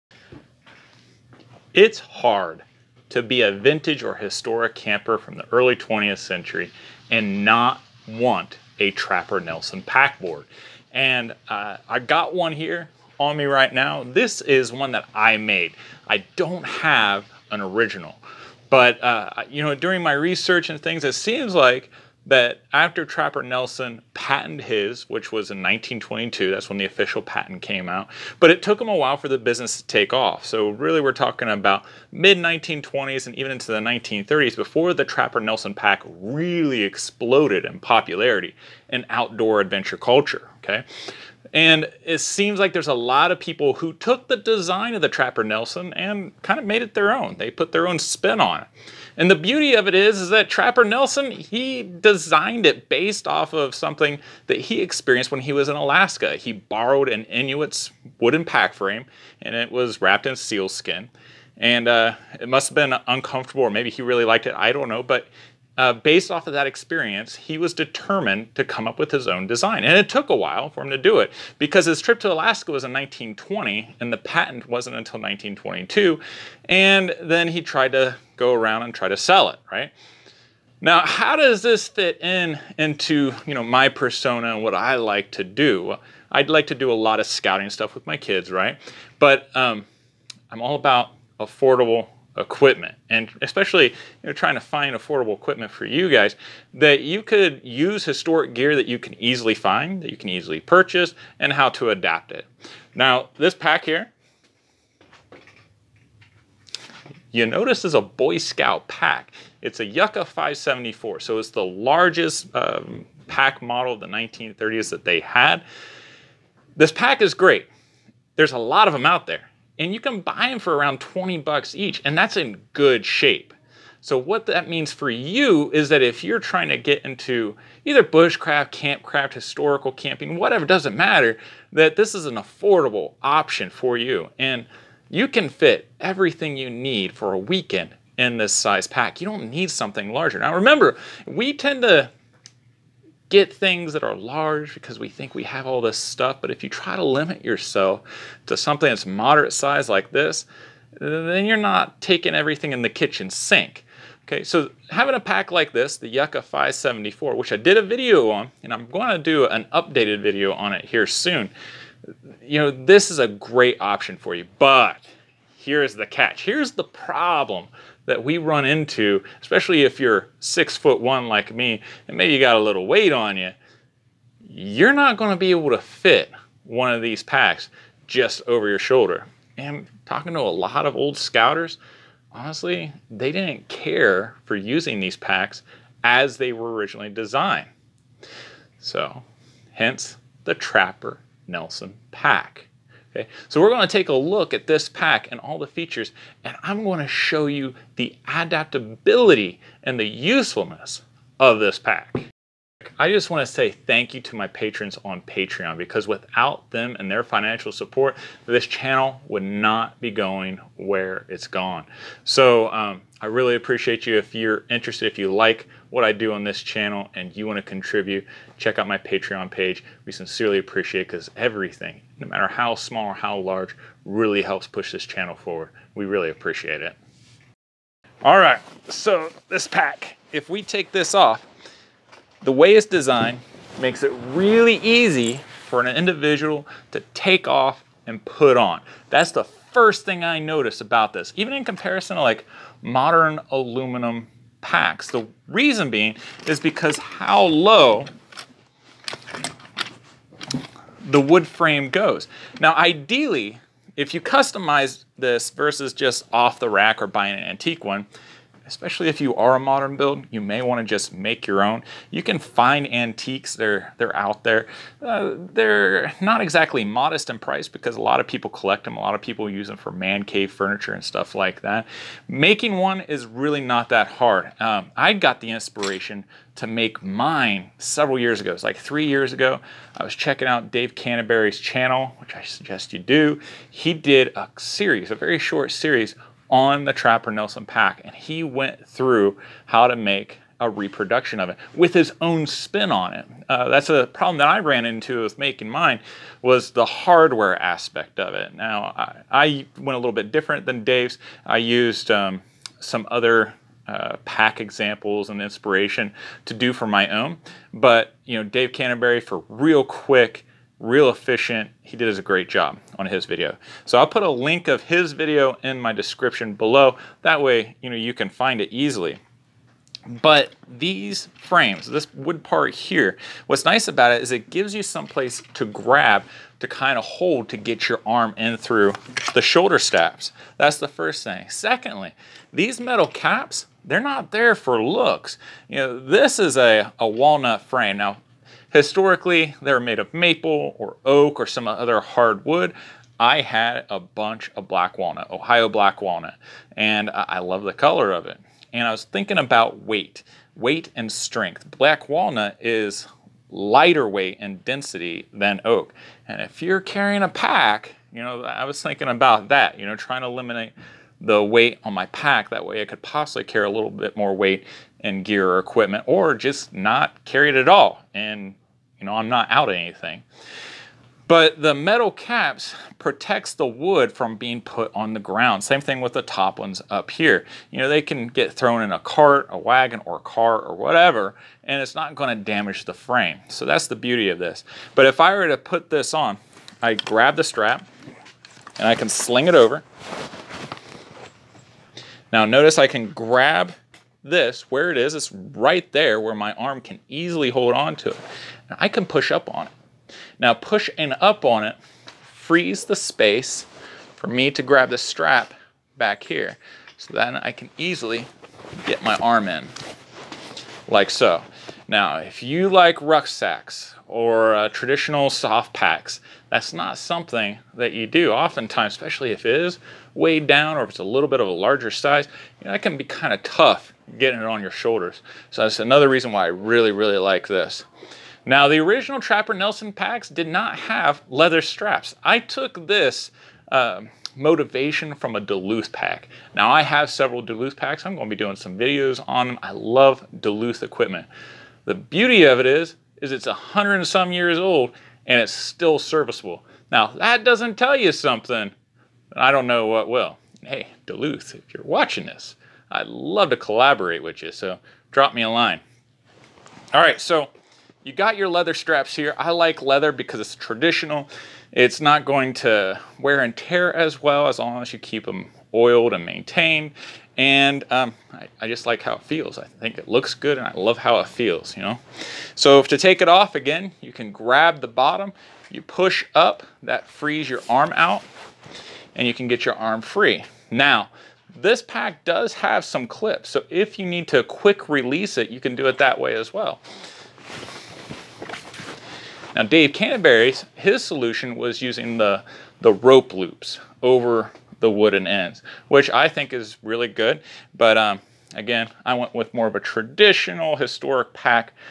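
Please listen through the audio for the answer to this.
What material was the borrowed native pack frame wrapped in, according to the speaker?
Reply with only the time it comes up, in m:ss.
1:00.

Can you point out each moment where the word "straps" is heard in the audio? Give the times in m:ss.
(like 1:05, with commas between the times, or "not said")
5:29, 6:27, 6:44, 7:11, 7:38.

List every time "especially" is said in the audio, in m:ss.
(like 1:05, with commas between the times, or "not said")
1:33, 2:49, 4:18, 6:58.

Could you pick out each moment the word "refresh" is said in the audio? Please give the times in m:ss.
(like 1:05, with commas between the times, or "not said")
not said.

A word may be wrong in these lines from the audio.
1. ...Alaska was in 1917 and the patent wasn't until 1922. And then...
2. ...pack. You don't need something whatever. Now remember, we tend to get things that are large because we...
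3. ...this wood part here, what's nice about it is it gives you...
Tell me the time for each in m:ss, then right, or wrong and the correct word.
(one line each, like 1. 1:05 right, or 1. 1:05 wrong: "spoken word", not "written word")
1. 1:12 wrong: "1920", not "1917"
2. 2:18 wrong: "larger", not "whatever"
3. 5:21 right.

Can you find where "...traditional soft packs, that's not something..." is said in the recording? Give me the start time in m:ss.
6:54.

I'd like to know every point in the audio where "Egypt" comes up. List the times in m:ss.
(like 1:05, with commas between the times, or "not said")
not said.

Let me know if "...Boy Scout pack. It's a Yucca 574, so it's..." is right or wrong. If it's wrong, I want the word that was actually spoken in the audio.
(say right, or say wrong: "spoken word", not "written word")
right.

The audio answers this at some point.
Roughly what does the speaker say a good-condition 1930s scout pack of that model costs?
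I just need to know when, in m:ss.
2:01.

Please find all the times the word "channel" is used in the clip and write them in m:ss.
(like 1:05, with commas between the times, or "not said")
3:28, 3:36, 3:45, 4:41.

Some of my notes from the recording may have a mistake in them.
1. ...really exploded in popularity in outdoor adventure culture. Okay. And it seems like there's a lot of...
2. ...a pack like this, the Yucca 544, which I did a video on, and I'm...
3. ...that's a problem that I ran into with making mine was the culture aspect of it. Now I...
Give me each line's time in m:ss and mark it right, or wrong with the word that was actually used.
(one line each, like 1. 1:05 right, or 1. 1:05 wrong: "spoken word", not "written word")
1. 0:36 right
2. 2:35 wrong: "574", not "544"
3. 4:53 wrong: "hardware", not "culture".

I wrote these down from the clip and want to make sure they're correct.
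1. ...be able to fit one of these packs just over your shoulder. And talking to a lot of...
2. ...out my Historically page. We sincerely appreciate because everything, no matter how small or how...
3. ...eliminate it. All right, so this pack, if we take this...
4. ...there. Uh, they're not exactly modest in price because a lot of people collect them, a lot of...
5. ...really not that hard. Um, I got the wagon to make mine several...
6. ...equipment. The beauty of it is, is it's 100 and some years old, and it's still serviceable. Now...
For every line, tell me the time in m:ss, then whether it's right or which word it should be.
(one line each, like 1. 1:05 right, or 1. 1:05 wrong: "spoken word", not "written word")
1. 2:55 right
2. 3:38 wrong: "Patreon", not "Historically"
3. 3:46 wrong: "appreciate", not "eliminate"
4. 4:24 right
5. 4:33 wrong: "inspiration", not "wagon"
6. 7:20 right.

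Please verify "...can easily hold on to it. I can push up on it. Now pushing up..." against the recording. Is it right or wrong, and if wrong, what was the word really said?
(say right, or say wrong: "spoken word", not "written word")
right.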